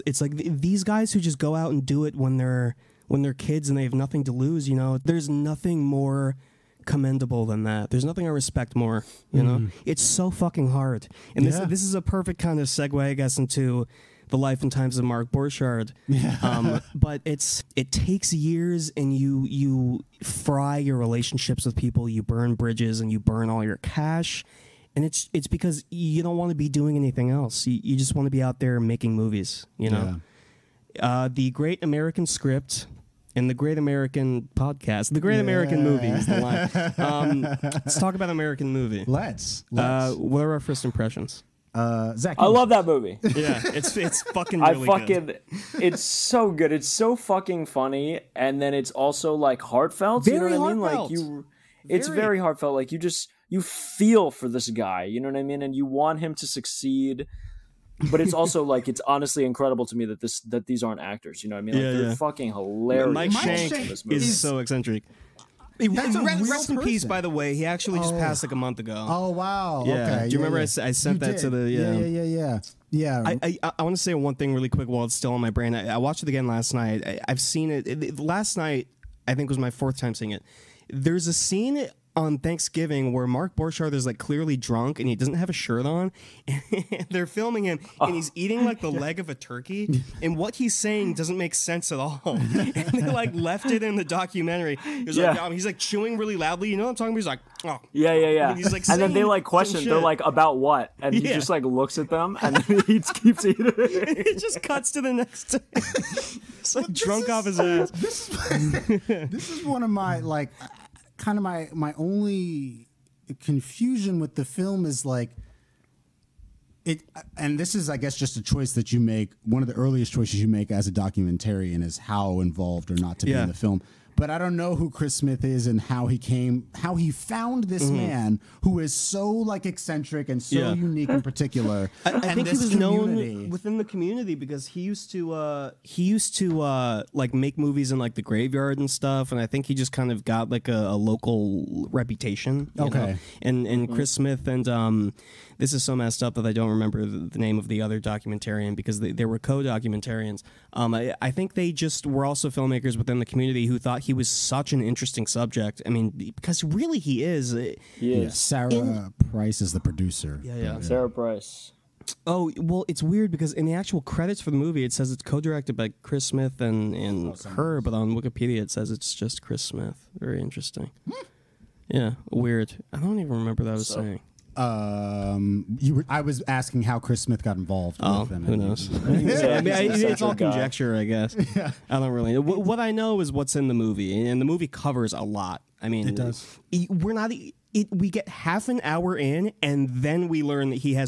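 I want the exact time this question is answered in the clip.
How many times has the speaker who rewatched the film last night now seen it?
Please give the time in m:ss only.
1:19.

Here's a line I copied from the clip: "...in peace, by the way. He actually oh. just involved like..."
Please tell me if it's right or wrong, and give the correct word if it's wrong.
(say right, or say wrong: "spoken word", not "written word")
wrong: "passed", not "involved".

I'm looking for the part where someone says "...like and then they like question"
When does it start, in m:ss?
1:38.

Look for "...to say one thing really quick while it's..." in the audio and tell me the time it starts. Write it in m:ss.
1:13.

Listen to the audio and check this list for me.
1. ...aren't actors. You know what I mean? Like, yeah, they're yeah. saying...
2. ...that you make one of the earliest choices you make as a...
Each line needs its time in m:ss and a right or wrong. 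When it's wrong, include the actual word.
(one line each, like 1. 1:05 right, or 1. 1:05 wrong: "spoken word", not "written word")
1. 1:00 wrong: "fucking", not "saying"
2. 1:58 right.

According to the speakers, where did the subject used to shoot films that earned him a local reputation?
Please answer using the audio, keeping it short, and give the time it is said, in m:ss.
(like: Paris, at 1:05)
The graveyard, at 2:18.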